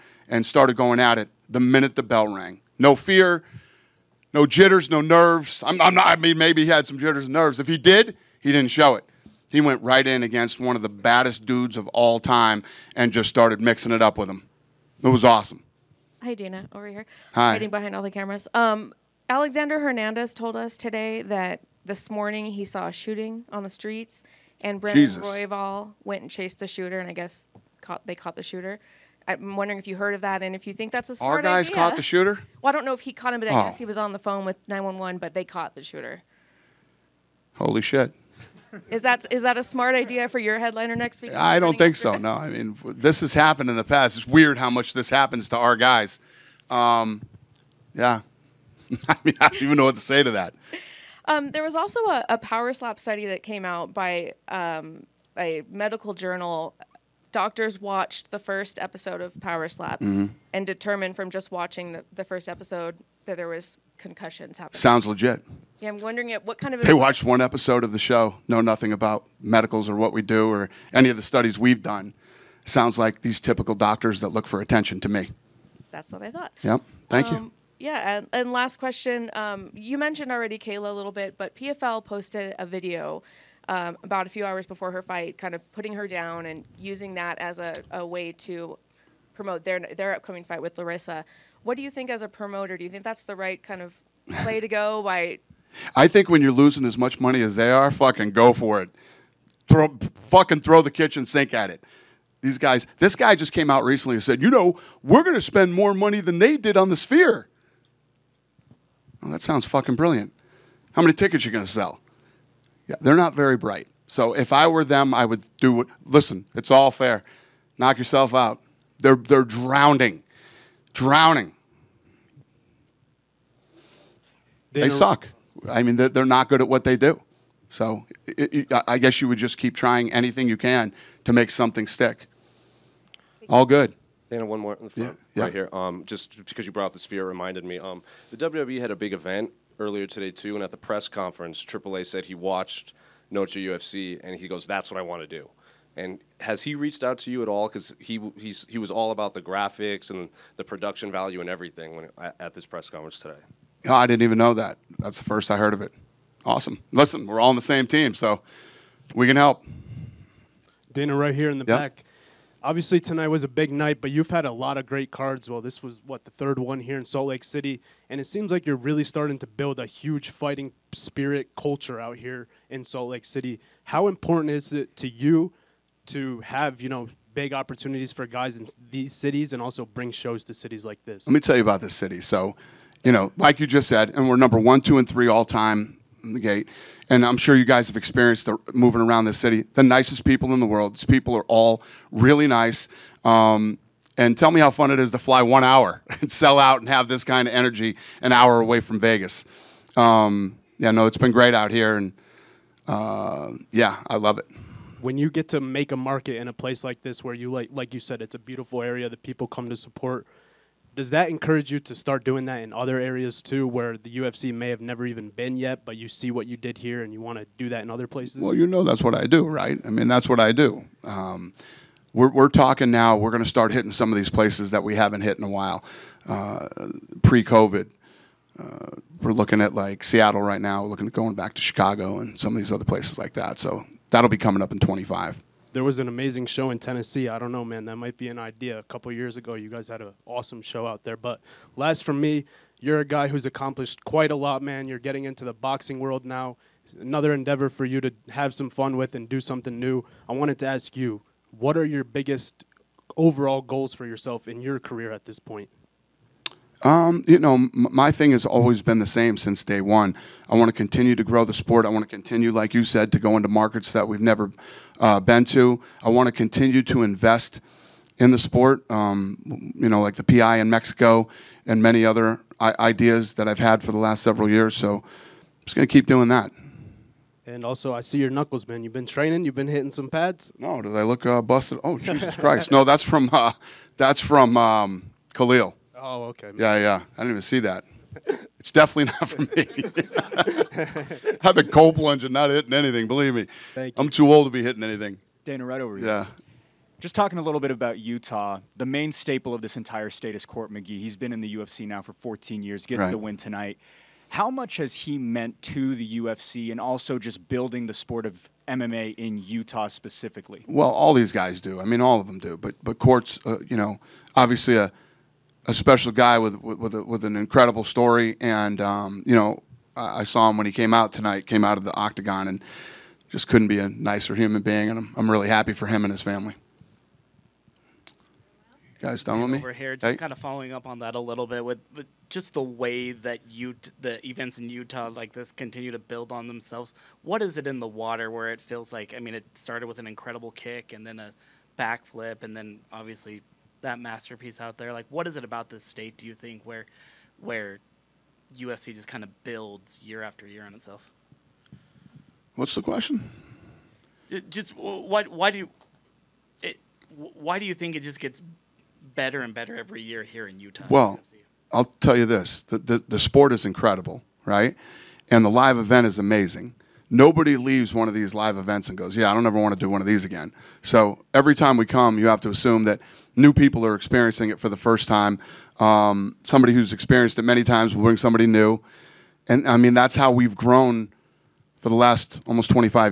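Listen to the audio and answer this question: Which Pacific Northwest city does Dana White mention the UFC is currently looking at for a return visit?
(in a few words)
Seattle.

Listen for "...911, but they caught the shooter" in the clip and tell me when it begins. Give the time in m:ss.
0:34.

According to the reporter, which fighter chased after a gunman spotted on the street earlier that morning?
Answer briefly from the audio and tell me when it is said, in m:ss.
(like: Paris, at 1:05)
Brandon Royval, at 0:24.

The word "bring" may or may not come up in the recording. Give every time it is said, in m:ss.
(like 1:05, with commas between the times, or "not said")
2:59, 6:18.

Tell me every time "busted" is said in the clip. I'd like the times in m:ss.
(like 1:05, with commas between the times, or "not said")
4:41.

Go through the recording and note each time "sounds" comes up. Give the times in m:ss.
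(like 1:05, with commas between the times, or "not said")
1:04, 1:12, 1:49.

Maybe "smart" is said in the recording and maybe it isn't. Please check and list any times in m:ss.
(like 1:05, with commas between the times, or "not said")
0:31, 0:39.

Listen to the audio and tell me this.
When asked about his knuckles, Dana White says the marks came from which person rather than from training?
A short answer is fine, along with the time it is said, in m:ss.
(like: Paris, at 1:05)
Khalil, at 4:45.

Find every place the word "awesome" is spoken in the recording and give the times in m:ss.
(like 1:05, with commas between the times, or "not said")
0:15, 2:36, 4:00.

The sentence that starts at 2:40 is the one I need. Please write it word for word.
Dana, right here in the yep.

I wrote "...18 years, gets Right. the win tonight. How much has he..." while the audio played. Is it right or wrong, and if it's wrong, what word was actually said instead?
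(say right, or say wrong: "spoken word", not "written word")
wrong: "14", not "18".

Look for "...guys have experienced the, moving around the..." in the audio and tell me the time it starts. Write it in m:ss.
3:07.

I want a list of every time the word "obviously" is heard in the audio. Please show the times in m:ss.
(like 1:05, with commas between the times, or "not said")
2:42, 5:14, 5:42.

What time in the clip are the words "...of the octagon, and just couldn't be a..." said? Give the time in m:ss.
5:21.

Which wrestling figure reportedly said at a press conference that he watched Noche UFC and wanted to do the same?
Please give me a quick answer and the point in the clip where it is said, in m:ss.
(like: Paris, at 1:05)
AAA, at 2:21.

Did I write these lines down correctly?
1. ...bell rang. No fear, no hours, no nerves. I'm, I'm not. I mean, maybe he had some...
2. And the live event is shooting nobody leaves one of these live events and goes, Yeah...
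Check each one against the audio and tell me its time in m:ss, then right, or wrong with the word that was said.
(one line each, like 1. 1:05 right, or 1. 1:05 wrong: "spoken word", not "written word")
1. 0:02 wrong: "jitters", not "hours"
2. 6:05 wrong: "amazing", not "shooting".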